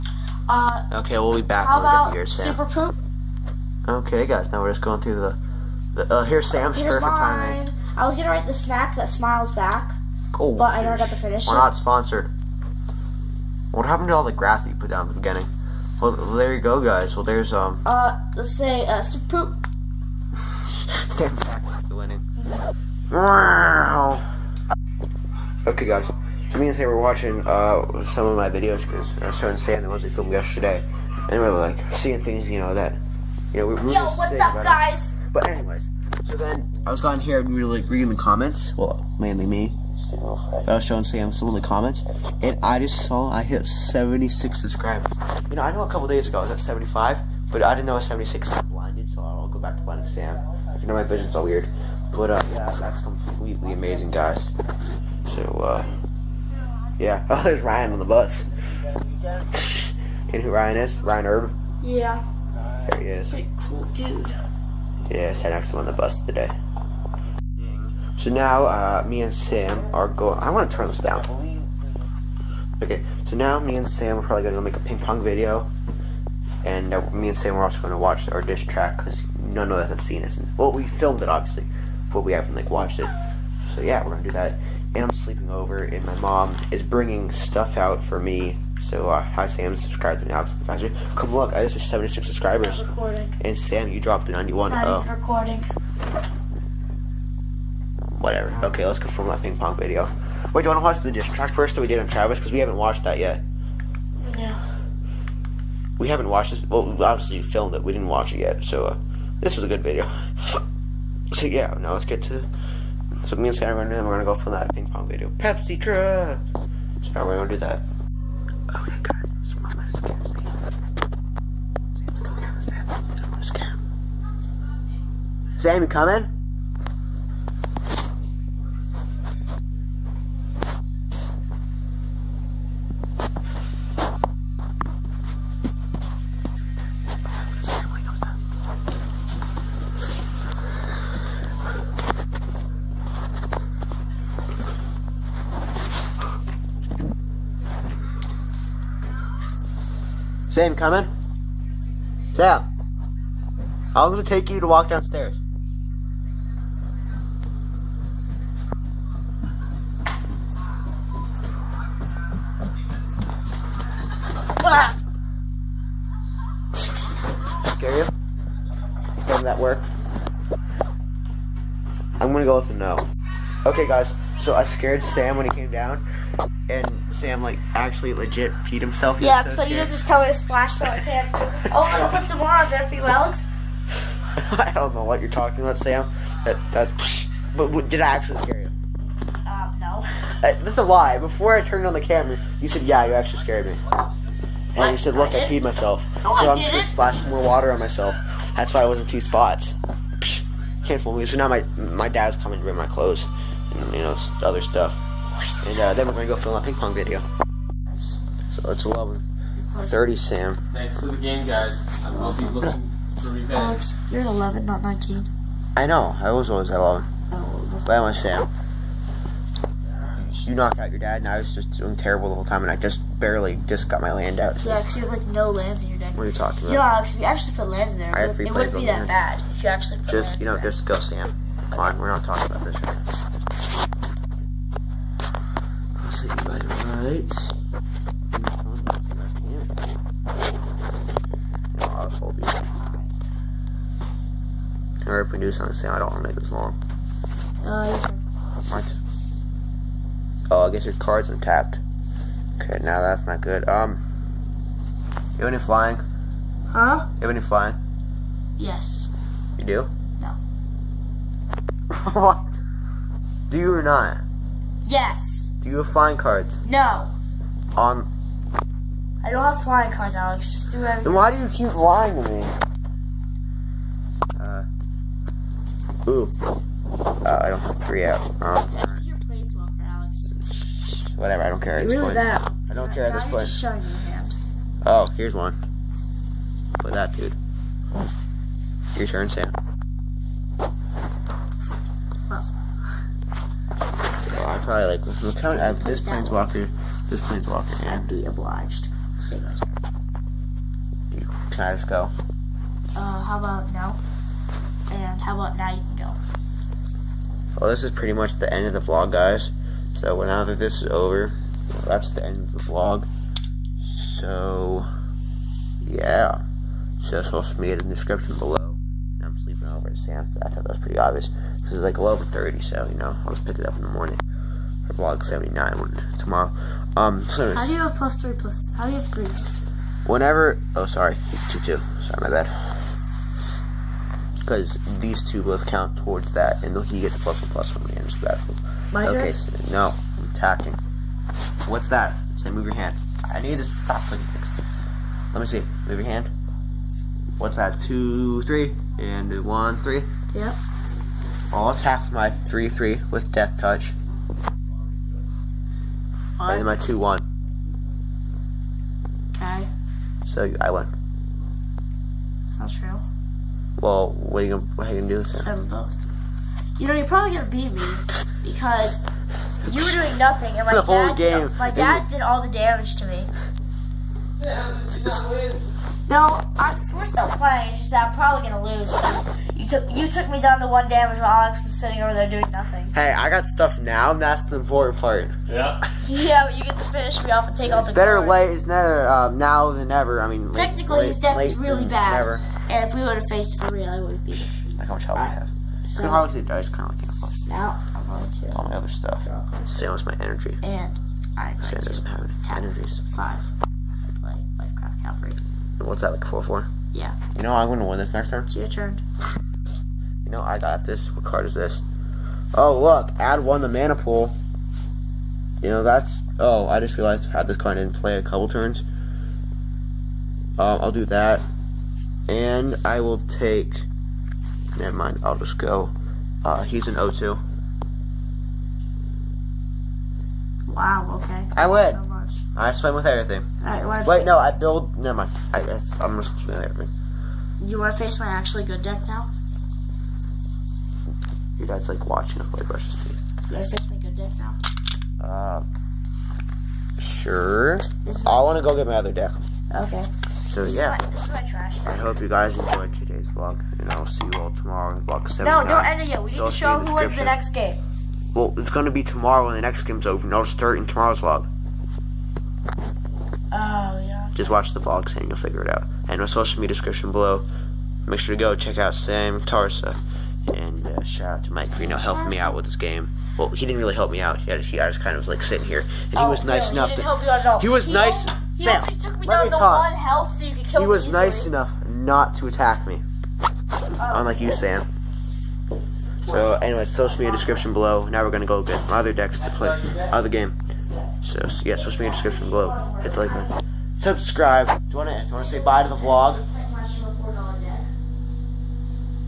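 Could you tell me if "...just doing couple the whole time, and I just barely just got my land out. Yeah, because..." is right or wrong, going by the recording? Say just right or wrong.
wrong.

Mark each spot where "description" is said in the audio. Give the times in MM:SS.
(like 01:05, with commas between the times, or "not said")
05:17, 07:46, 08:07, 08:12.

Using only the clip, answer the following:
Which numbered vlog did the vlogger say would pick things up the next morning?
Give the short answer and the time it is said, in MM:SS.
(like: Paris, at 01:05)
vlog 79, at 05:24.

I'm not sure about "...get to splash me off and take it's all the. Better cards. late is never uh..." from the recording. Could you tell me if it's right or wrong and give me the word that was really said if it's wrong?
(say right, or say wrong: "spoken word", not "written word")
wrong: "finish", not "splash".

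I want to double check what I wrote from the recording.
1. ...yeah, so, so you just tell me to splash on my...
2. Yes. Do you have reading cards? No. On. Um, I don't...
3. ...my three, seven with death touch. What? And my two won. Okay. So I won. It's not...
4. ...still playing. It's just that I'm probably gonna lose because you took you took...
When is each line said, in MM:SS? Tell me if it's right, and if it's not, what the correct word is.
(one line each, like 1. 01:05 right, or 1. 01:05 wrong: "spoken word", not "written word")
1. 02:59 right
2. 04:24 wrong: "flying", not "reading"
3. 05:52 wrong: "three", not "seven"
4. 06:17 right.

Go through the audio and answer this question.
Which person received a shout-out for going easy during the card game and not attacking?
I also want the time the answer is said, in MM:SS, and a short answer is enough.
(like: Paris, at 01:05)
Mike, at 07:51.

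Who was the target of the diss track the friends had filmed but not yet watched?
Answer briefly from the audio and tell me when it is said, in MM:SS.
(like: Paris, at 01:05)
Travis, at 01:42.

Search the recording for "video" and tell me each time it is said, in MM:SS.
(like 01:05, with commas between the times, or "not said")
00:28, 01:15, 01:39, 01:49, 01:55, 03:26.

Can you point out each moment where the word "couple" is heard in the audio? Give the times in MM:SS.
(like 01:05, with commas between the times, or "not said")
00:45, 06:58.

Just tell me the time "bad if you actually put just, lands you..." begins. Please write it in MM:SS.
03:49.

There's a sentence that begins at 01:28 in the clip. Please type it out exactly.
So uh, hi Sam, subscribe to me, Alex.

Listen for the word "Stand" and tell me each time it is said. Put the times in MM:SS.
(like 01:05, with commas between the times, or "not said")
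00:21.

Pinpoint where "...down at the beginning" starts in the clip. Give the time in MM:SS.
00:14.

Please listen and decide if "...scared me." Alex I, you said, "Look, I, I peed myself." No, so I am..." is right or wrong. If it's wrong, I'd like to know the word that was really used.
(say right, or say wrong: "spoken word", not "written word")
wrong: "And", not "Alex".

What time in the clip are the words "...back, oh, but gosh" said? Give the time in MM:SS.
00:09.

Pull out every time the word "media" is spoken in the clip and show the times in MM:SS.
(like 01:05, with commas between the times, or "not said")
05:17, 07:46, 08:07, 08:12.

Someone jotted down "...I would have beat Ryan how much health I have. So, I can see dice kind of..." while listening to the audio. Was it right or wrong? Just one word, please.
wrong.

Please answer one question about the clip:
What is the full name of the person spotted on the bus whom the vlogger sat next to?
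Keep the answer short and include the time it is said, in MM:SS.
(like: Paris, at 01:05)
Ryan Herb, at 01:01.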